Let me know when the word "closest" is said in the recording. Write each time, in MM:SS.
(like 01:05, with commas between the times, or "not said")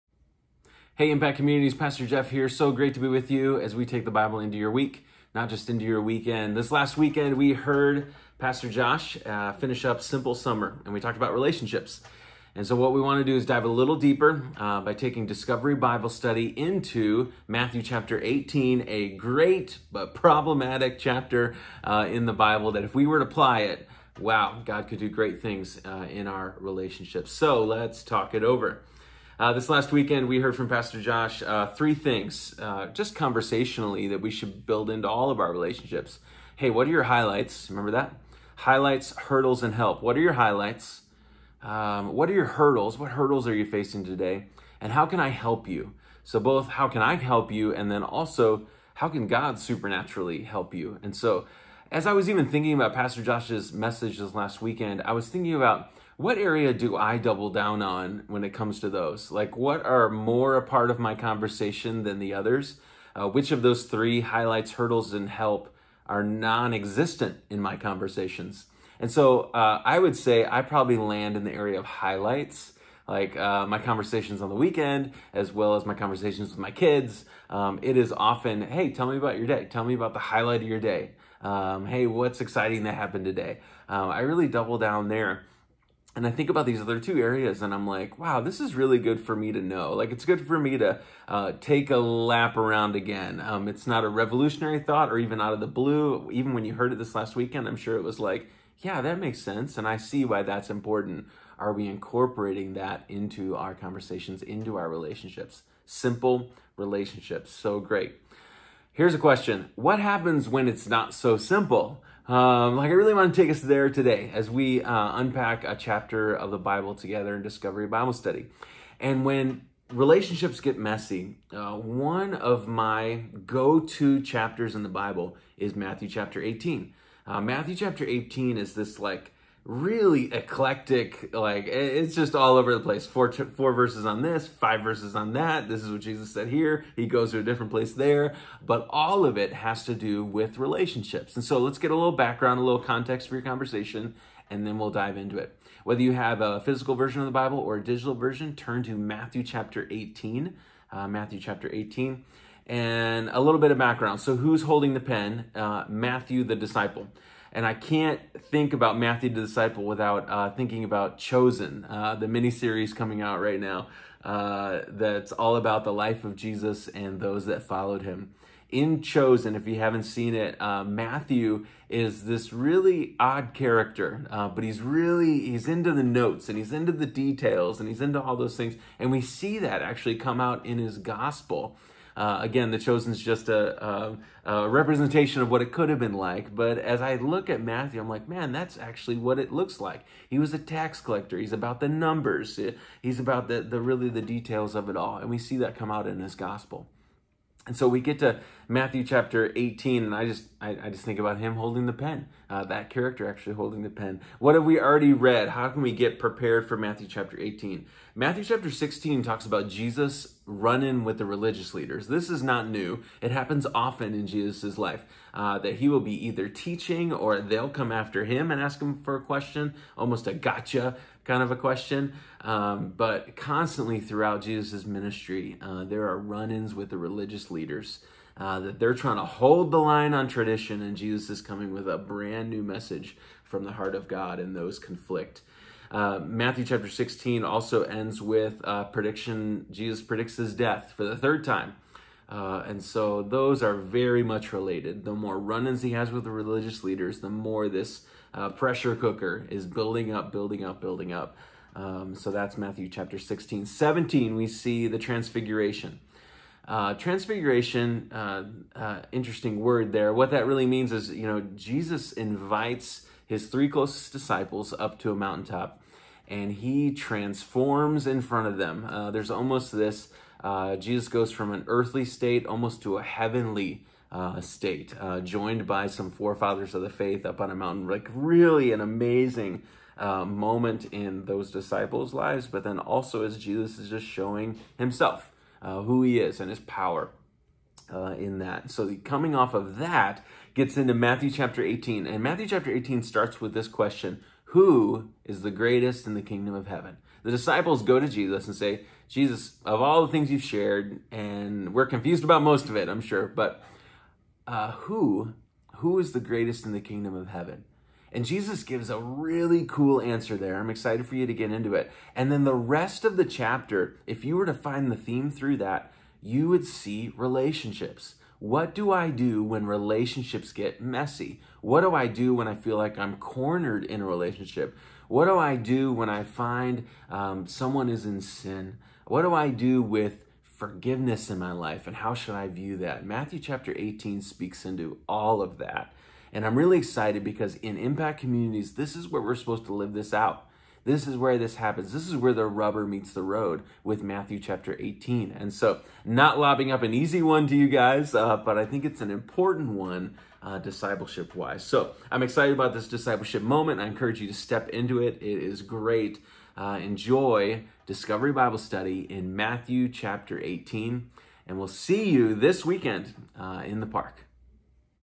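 04:23.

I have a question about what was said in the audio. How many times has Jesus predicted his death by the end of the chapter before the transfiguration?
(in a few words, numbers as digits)
3.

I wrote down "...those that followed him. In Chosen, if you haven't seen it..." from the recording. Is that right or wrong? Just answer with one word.
right.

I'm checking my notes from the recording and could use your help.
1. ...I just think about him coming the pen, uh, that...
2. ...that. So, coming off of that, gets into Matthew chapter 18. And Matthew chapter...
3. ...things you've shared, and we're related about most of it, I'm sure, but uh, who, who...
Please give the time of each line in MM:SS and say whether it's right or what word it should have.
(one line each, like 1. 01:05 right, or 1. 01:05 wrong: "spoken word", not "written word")
1. 03:20 wrong: "holding", not "coming"
2. 04:48 right
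3. 05:00 wrong: "confused", not "related".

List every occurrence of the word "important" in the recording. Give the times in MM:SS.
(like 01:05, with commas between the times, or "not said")
01:40, 05:49.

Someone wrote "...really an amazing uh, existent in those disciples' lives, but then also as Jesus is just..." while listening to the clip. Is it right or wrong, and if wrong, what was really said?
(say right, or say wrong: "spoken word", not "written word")
wrong: "moment", not "existent".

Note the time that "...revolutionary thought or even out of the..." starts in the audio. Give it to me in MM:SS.
01:34.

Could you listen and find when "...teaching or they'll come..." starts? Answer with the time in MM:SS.
03:36.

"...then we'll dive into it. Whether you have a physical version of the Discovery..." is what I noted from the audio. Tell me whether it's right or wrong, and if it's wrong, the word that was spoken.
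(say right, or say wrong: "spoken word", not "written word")
wrong: "Bible", not "Discovery".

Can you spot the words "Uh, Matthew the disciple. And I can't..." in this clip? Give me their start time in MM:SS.
02:35.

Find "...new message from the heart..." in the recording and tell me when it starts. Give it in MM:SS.
03:52.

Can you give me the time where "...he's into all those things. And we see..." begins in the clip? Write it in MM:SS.
02:57.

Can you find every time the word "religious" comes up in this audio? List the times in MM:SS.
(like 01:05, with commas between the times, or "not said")
03:31, 03:46, 04:06.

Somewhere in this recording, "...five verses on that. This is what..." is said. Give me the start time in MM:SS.
02:14.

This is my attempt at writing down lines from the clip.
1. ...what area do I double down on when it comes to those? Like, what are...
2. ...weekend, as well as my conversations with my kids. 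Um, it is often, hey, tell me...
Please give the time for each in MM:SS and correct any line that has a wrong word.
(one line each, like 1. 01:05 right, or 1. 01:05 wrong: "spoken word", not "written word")
1. 00:56 right
2. 01:14 right.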